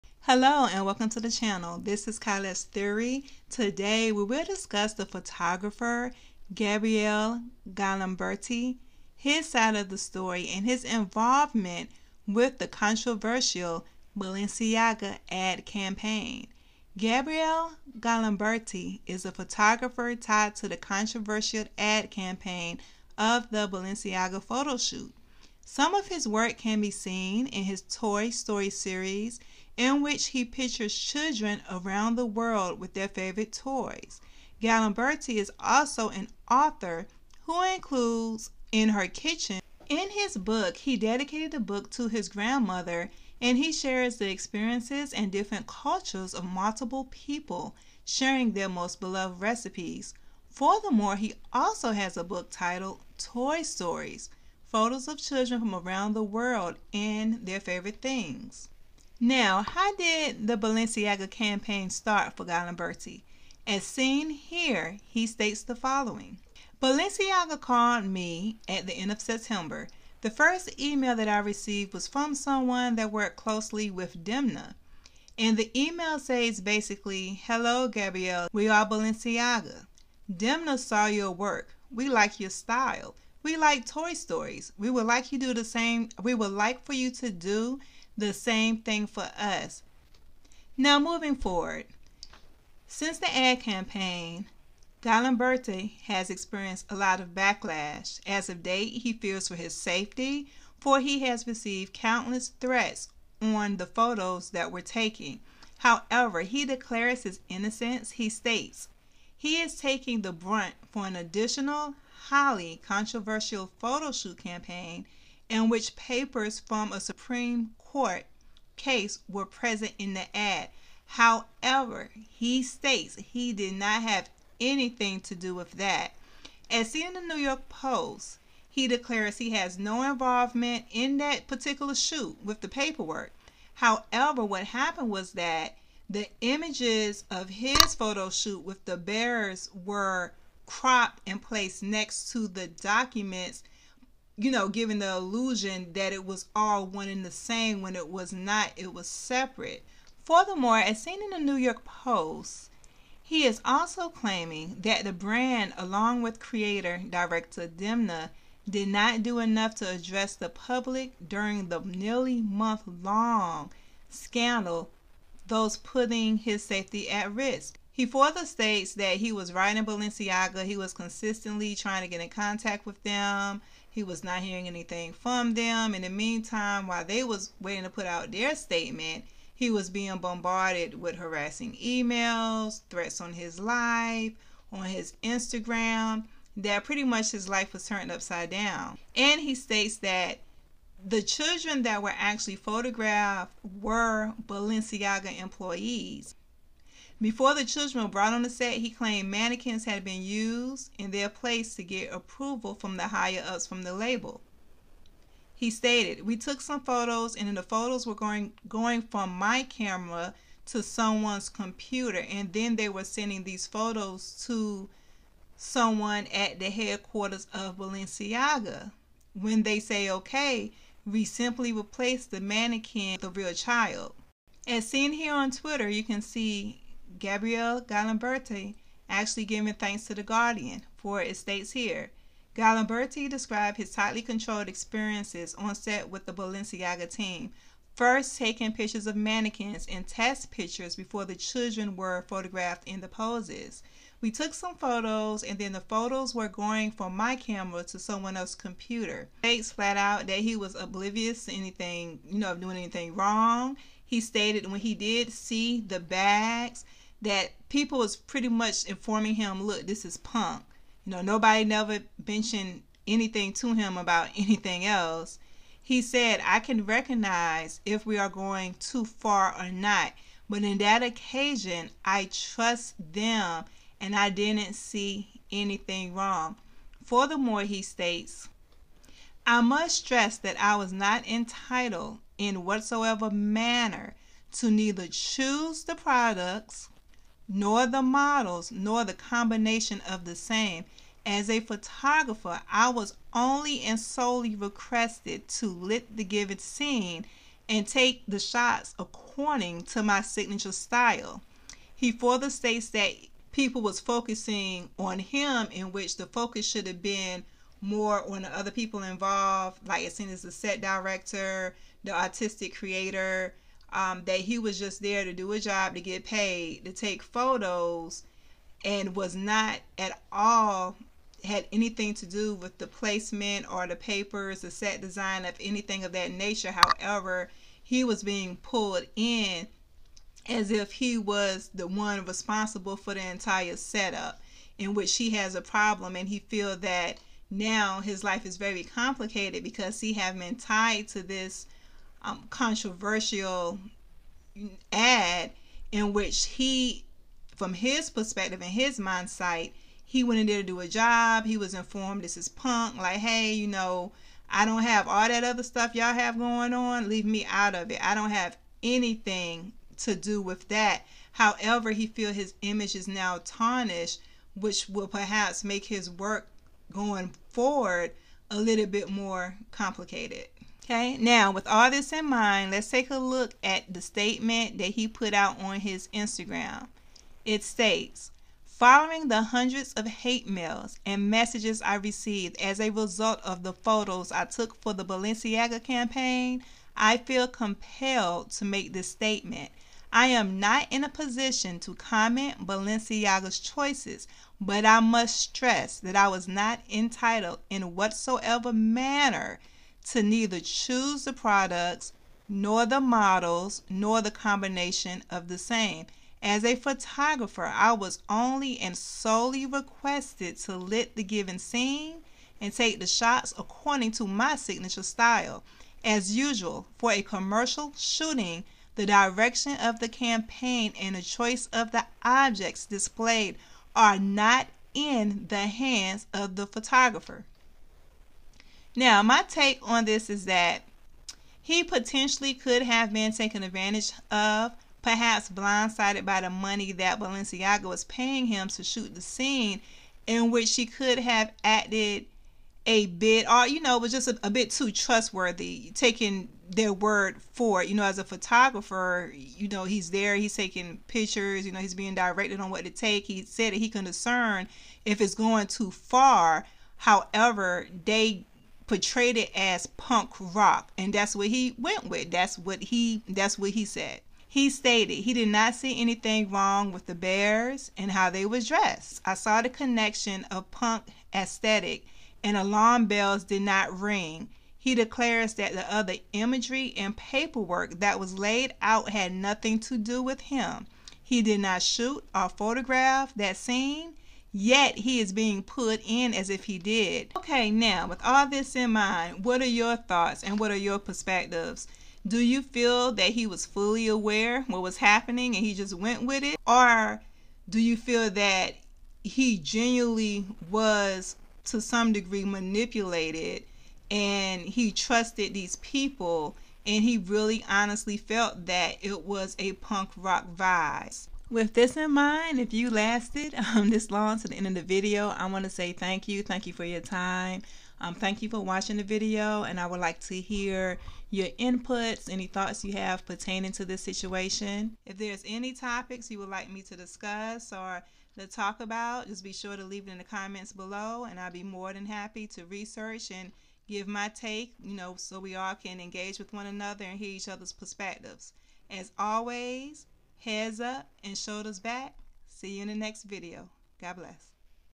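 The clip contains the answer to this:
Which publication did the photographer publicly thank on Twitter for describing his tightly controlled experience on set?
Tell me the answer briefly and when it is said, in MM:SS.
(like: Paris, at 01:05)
The Guardian, at 03:50.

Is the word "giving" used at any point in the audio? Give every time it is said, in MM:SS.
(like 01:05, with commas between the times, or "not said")
02:24, 03:49.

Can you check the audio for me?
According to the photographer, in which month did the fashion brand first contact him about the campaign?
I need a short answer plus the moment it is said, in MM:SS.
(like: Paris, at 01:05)
September, at 01:08.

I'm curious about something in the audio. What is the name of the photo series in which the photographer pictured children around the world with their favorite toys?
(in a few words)
Toy Story.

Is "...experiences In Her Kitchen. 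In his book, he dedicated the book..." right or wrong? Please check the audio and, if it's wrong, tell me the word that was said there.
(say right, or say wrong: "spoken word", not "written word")
wrong: "includes", not "experiences".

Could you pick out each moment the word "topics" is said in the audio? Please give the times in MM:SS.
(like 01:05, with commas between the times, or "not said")
08:45.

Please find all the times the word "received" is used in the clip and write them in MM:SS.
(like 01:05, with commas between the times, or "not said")
01:11, 01:41, 06:21.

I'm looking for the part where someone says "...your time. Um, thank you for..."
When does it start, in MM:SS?
08:36.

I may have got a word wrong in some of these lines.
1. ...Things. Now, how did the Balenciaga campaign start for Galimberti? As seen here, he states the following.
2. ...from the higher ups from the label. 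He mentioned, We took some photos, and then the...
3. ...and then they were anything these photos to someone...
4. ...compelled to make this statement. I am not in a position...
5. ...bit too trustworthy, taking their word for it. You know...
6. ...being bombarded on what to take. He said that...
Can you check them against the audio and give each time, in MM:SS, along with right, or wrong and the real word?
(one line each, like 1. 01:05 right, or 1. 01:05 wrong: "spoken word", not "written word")
1. 00:58 right
2. 03:22 wrong: "stated", not "mentioned"
3. 03:32 wrong: "sending", not "anything"
4. 06:27 right
5. 07:24 right
6. 07:31 wrong: "directed", not "bombarded".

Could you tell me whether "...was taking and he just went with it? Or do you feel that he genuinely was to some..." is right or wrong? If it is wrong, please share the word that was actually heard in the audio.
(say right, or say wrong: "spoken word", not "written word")
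wrong: "happening", not "taking".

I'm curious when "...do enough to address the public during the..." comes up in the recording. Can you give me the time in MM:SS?
02:39.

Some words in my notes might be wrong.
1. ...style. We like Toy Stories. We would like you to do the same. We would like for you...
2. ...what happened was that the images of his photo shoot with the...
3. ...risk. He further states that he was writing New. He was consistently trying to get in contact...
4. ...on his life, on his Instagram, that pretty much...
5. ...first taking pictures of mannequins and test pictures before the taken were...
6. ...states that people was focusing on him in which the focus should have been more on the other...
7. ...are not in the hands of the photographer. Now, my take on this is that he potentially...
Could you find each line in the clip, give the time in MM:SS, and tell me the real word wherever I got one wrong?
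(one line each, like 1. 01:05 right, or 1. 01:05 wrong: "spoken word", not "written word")
1. 01:22 right
2. 02:14 right
3. 02:47 wrong: "Balenciaga", not "New"
4. 03:03 right
5. 03:57 wrong: "children", not "taken"
6. 05:02 right
7. 07:03 right.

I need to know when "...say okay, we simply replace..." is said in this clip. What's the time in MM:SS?
03:39.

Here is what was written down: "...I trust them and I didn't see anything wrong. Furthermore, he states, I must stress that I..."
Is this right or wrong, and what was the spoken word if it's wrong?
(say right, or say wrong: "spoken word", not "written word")
right.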